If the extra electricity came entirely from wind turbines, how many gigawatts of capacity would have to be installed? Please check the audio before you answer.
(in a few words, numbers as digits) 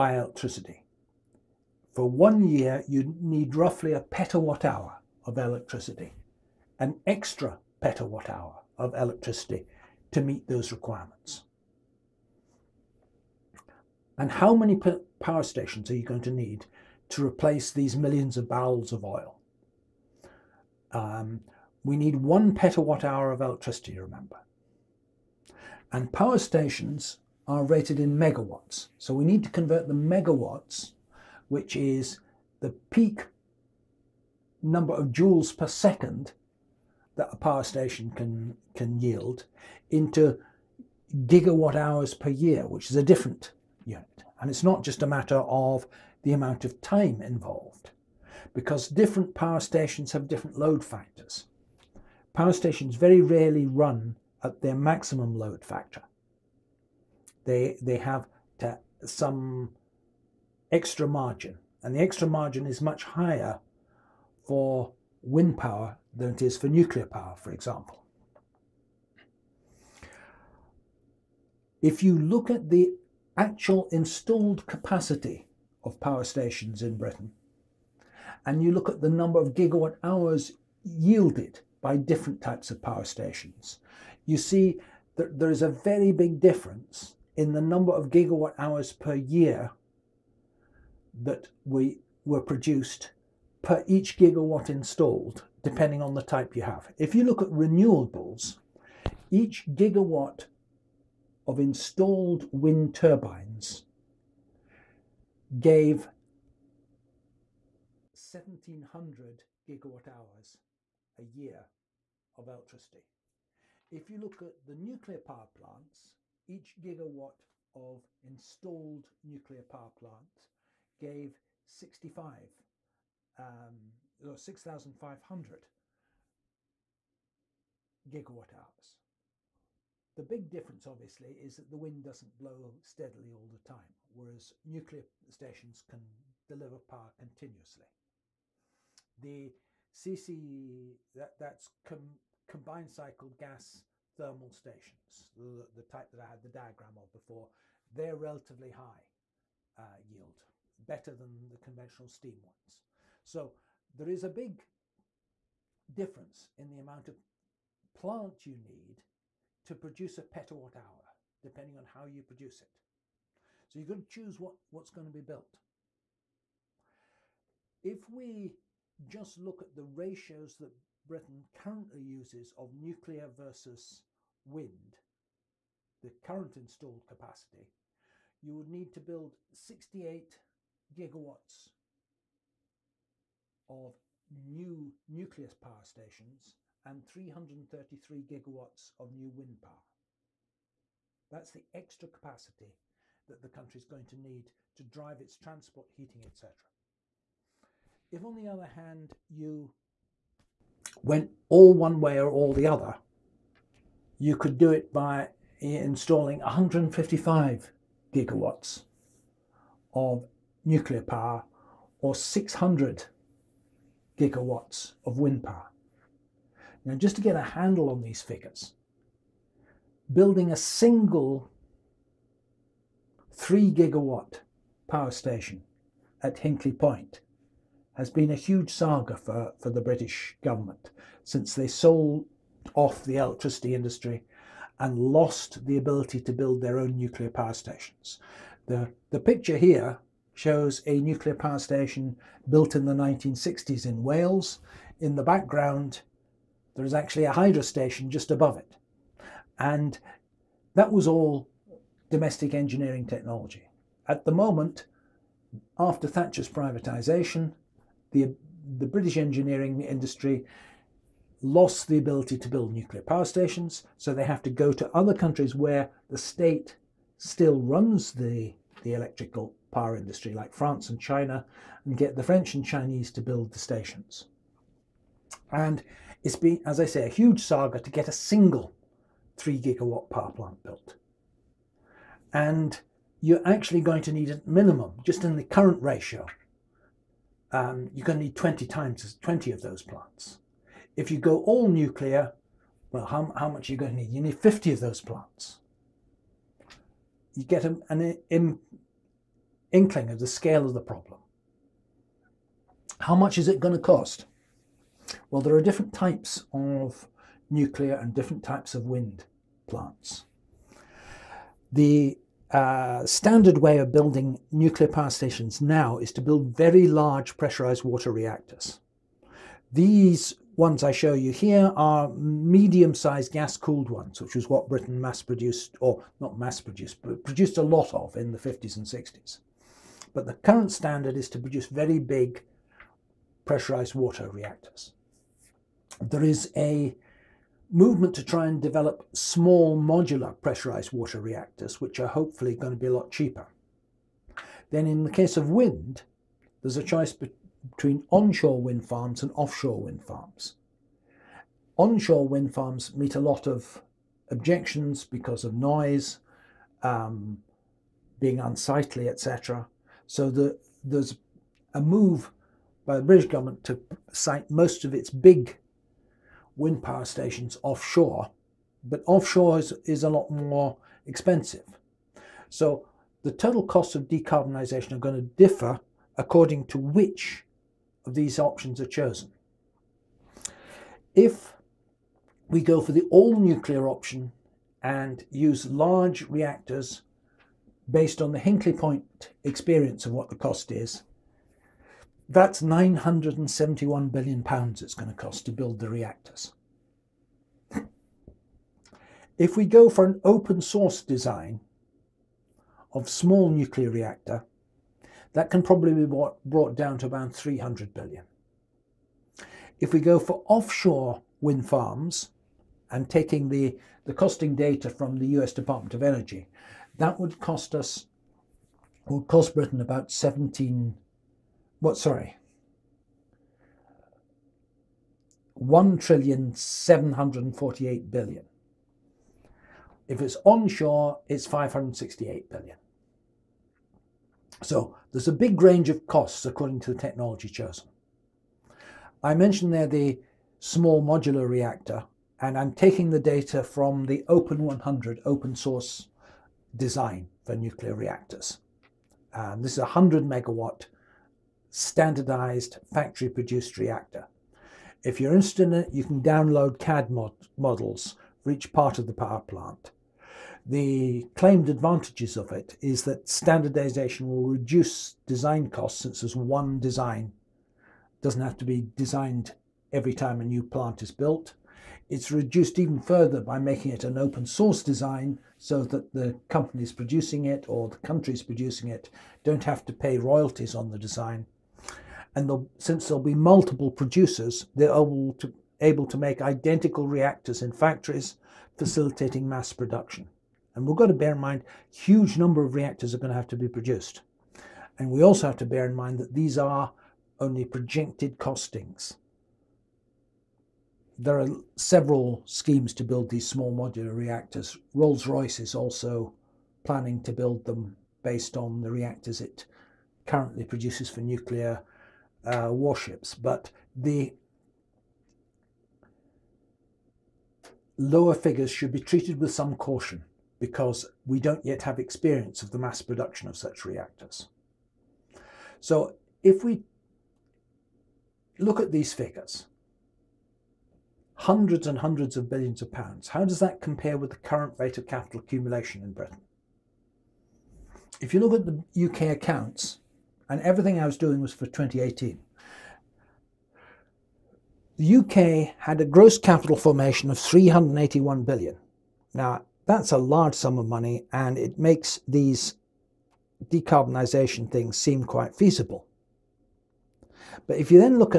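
600 gigawatts.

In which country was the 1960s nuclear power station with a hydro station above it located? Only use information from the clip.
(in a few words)
Wales.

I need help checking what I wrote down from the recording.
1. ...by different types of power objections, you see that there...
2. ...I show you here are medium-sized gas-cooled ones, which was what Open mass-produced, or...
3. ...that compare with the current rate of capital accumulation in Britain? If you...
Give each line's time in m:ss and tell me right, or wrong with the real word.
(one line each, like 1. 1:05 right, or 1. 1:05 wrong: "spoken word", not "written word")
1. 1:21 wrong: "stations", not "objections"
2. 5:20 wrong: "Britain", not "Open"
3. 8:53 right.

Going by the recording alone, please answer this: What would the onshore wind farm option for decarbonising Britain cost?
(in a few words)
568 billion.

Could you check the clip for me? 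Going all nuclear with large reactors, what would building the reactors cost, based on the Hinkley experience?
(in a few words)
£971 billion.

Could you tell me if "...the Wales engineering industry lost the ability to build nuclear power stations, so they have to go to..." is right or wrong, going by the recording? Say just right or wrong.
wrong.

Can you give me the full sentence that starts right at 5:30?
But the current standard is to produce very big pressurized water reactors.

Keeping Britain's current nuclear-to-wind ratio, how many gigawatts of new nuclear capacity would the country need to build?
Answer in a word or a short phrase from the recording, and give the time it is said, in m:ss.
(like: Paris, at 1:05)
68 gigawatts, at 2:59.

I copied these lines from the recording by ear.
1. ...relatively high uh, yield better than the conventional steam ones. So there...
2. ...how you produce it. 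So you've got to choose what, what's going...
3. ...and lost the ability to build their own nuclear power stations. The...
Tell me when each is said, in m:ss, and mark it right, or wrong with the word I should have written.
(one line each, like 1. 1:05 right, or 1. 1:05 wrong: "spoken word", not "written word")
1. 2:28 right
2. 2:41 right
3. 3:54 right.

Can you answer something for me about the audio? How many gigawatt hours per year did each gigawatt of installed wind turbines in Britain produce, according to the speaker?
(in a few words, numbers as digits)
1700.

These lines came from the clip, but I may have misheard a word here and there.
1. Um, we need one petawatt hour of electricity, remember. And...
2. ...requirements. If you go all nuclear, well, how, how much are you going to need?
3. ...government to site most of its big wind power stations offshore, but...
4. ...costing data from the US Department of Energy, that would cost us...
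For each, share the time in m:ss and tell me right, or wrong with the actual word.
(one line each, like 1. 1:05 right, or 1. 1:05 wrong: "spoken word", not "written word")
1. 0:20 right
2. 4:49 wrong: "plants", not "requirements"
3. 6:03 right
4. 6:54 right.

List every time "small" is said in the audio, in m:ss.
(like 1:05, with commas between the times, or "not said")
5:39, 6:43, 7:20, 8:23.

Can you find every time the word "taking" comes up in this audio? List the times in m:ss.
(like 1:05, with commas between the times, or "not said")
6:53, 7:22.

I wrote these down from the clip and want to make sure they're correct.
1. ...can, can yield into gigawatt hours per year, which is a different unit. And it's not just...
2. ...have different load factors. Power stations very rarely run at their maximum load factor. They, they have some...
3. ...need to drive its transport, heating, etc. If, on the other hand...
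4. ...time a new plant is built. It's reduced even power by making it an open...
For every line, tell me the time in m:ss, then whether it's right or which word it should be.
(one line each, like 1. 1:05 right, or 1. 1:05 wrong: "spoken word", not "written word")
1. 0:38 right
2. 0:50 right
3. 3:14 right
4. 7:50 wrong: "further", not "power".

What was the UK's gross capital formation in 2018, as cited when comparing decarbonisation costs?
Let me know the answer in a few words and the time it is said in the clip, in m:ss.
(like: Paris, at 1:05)
381 billion, at 9:07.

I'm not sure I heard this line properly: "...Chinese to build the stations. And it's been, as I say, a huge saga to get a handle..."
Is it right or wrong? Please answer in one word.
wrong.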